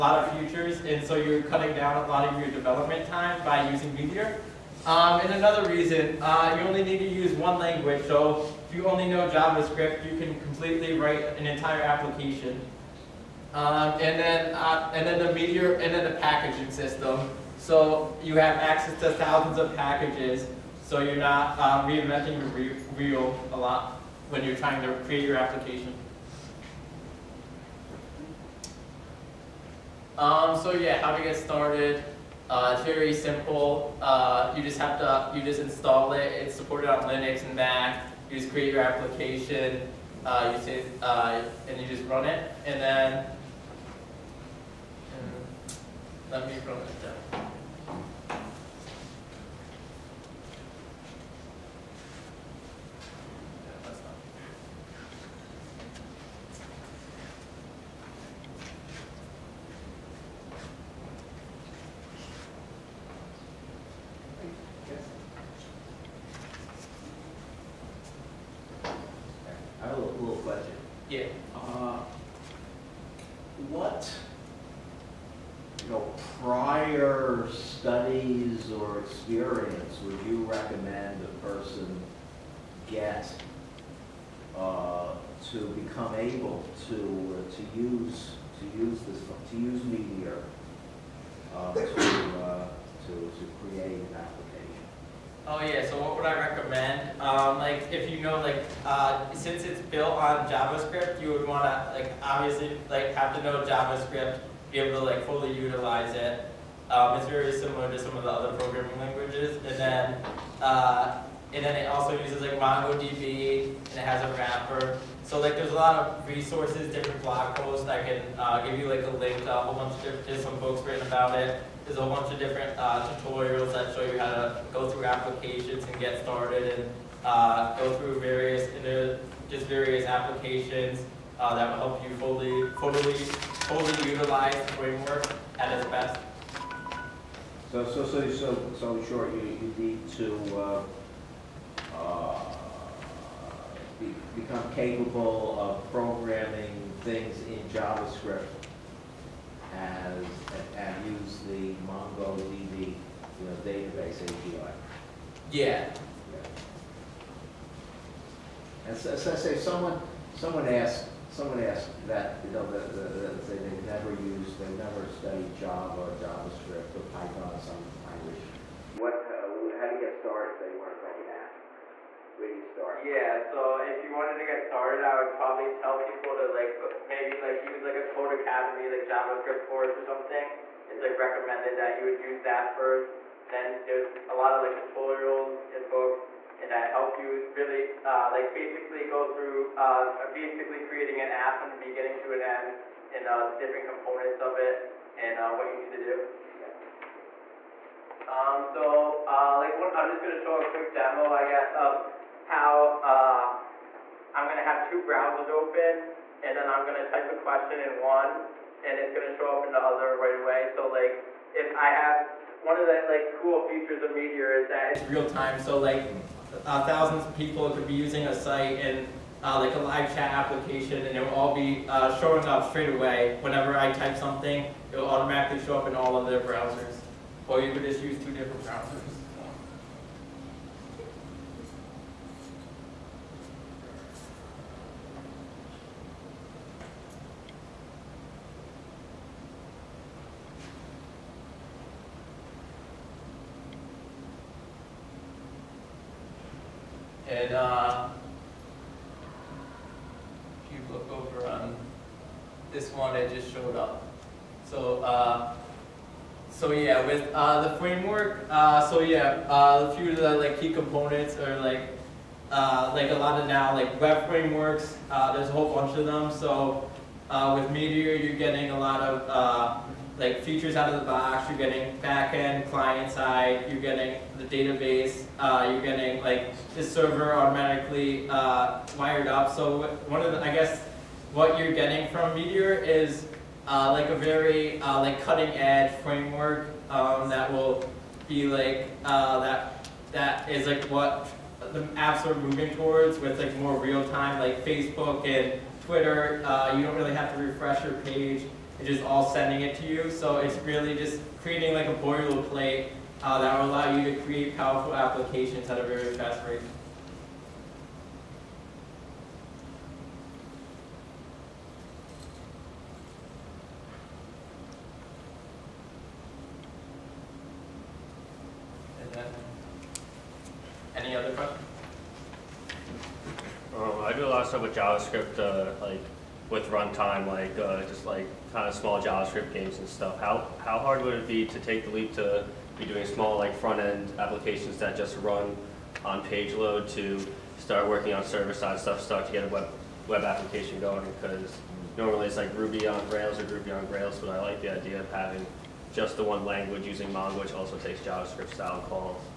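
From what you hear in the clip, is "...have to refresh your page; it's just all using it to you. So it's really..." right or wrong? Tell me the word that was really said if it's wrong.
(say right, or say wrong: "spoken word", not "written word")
wrong: "sending", not "using".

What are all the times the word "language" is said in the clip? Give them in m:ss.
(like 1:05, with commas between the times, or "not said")
0:07, 1:48, 2:48, 5:46.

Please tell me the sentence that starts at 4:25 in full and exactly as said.
Uh, there's a whole bunch of them.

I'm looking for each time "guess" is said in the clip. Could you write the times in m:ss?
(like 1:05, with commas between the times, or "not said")
3:21, 4:40.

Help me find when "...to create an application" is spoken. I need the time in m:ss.
1:33.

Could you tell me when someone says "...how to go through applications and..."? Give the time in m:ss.
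2:04.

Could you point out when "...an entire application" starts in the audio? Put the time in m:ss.
0:11.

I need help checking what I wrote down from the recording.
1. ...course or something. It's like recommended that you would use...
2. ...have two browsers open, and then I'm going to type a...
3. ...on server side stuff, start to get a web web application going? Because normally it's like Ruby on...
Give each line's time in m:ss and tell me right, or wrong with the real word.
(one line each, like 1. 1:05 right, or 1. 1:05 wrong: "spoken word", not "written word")
1. 2:59 right
2. 3:24 right
3. 5:38 right.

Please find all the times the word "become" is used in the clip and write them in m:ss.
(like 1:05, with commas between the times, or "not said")
1:25, 2:24.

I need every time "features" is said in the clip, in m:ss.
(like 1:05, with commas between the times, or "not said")
0:00, 3:33, 4:30.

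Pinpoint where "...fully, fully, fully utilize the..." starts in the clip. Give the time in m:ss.
2:12.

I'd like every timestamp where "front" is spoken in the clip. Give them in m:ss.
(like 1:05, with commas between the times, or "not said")
5:33.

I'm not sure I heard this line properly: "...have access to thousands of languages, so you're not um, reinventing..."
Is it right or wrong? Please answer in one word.
wrong.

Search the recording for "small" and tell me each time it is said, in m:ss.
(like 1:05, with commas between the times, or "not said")
5:28, 5:33.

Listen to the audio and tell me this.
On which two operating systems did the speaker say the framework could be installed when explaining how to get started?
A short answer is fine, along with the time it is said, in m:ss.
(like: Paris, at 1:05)
Linux and Mac, at 0:37.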